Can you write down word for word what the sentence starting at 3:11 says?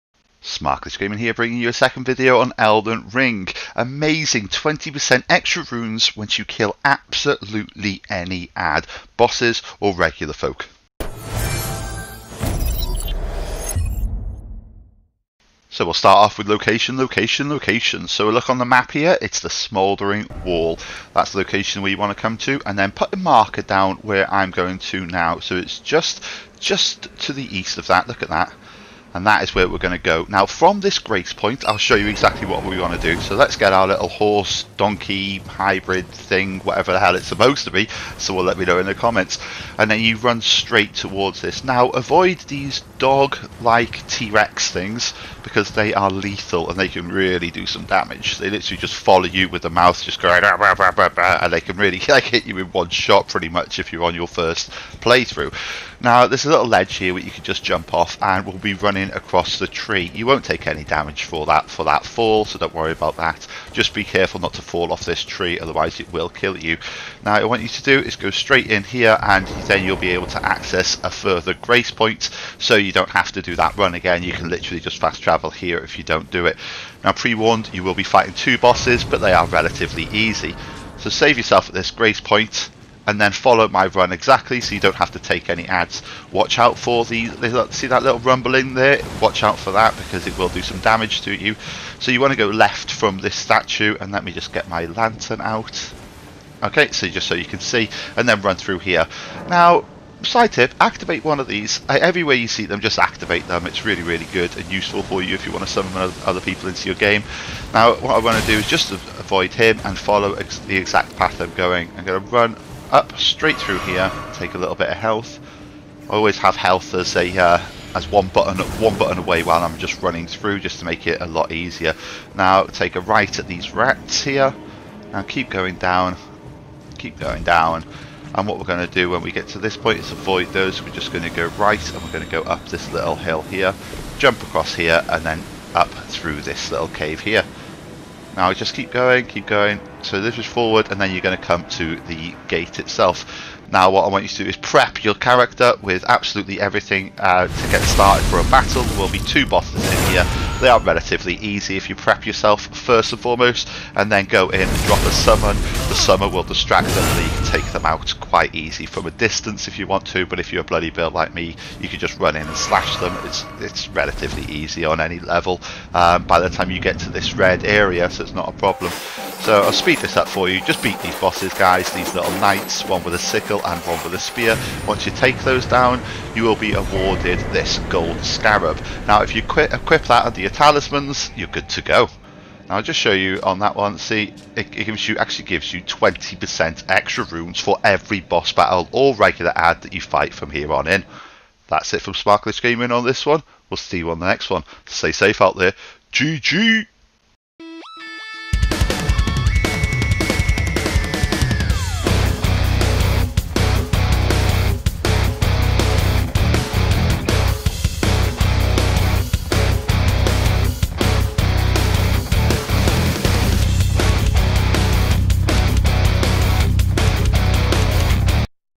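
That's it from Smart Glitch Gaming on this one.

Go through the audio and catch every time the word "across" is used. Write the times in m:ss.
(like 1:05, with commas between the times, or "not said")
0:59, 2:14.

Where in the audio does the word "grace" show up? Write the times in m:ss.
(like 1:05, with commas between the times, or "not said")
0:30, 1:11, 1:21.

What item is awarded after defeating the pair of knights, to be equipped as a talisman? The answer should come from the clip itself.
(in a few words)
Gold scarab.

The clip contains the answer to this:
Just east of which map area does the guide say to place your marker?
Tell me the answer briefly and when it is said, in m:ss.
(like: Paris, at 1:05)
Smouldering Wall, at 0:19.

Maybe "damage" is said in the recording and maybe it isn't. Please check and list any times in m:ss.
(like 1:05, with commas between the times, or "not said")
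0:47, 1:00, 1:30.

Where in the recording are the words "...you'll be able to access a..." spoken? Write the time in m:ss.
1:09.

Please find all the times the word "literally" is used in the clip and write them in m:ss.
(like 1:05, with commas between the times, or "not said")
0:48, 1:14.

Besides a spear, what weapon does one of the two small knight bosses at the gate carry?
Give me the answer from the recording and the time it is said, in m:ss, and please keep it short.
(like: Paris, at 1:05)
Sickle, at 2:53.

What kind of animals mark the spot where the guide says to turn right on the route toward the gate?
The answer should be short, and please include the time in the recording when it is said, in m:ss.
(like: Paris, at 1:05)
Rats, at 2:03.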